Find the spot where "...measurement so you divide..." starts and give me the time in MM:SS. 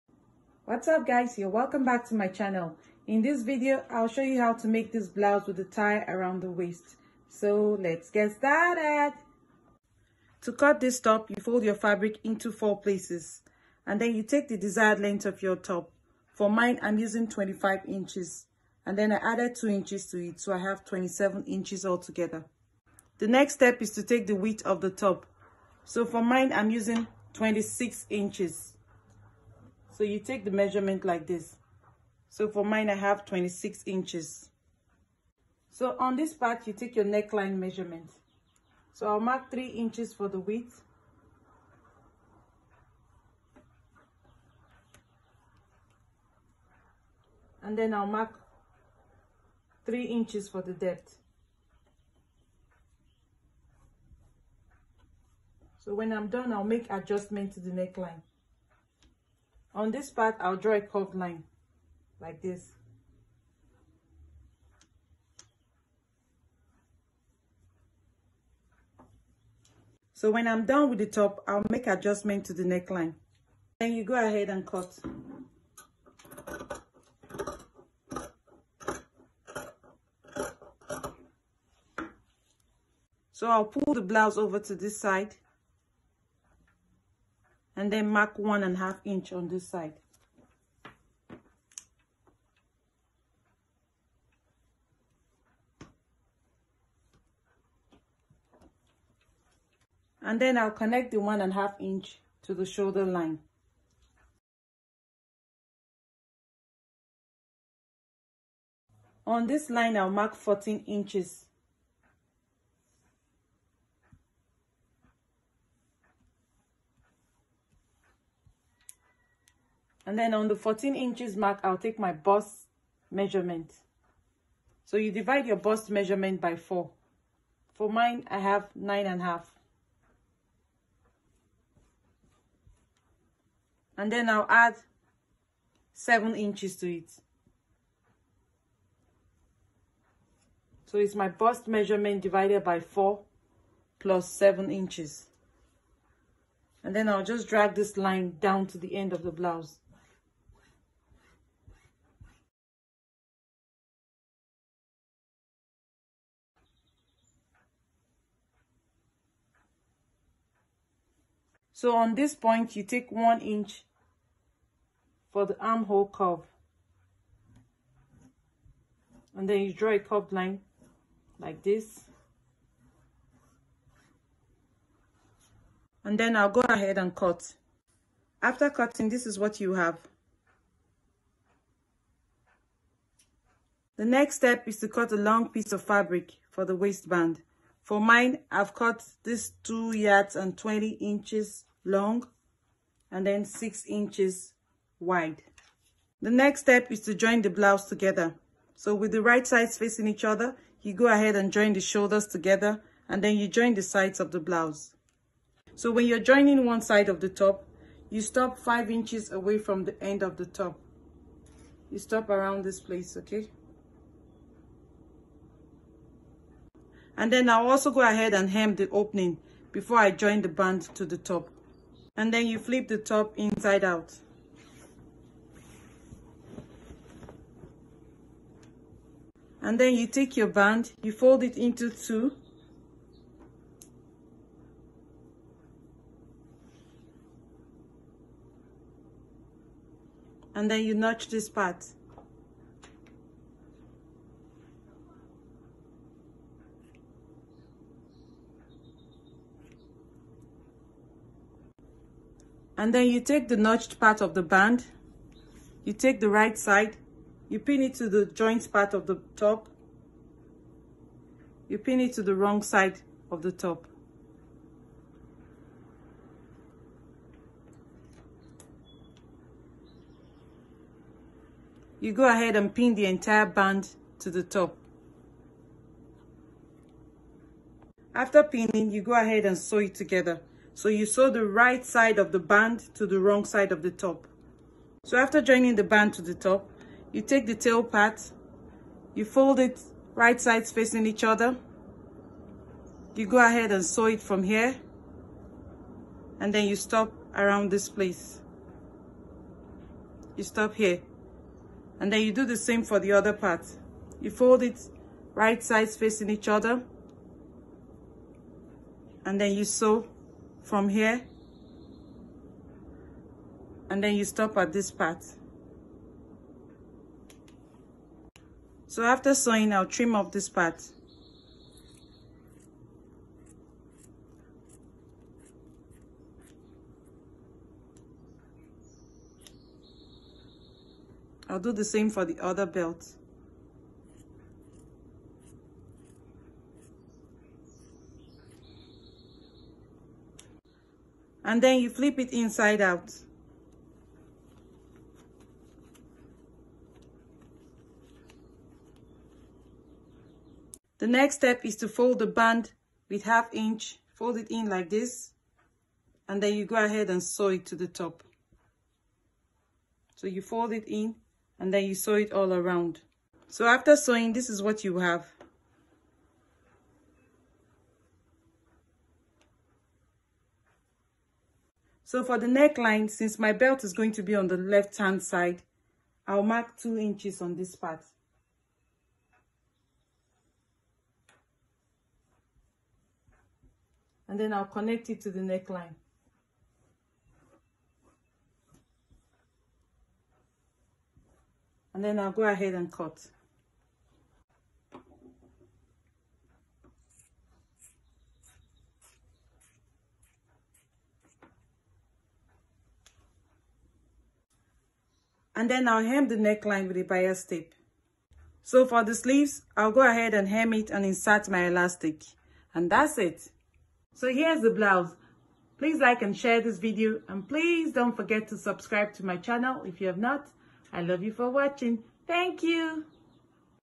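02:03.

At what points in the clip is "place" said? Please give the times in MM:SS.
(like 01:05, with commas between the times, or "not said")
00:12, 03:32, 04:57.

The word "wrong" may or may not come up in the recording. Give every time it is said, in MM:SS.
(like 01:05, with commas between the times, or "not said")
04:22, 04:43.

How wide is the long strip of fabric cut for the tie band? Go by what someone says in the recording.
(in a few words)
6 inches.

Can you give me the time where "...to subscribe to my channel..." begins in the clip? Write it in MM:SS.
06:58.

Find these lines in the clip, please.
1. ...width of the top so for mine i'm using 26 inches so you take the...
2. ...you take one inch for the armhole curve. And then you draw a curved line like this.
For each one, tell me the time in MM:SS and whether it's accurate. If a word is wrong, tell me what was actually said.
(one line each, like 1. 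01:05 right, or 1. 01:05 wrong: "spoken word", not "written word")
1. 00:24 right
2. 02:42 right.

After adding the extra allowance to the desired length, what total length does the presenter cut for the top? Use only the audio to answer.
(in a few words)
27 inches.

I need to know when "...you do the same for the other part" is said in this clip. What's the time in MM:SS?
05:02.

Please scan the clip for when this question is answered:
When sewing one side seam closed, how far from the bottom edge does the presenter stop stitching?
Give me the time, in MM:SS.
03:28.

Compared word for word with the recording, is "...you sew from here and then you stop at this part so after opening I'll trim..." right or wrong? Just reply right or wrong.
wrong.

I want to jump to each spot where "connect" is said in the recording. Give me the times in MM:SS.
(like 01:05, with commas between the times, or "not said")
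01:40, 06:24.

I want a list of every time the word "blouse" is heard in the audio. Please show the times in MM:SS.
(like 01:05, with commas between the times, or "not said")
00:05, 01:24, 02:29, 03:17, 03:24, 06:54.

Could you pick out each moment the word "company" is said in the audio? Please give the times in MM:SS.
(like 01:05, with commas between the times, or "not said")
not said.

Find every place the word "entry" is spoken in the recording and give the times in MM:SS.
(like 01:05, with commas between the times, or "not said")
not said.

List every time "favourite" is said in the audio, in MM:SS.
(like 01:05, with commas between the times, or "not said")
not said.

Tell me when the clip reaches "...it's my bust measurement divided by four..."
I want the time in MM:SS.
02:20.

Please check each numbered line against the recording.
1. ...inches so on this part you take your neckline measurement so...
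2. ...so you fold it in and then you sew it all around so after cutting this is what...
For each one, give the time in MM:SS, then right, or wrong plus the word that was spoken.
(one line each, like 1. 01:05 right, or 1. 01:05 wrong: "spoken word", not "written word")
1. 00:33 right
2. 06:00 wrong: "sewing", not "cutting".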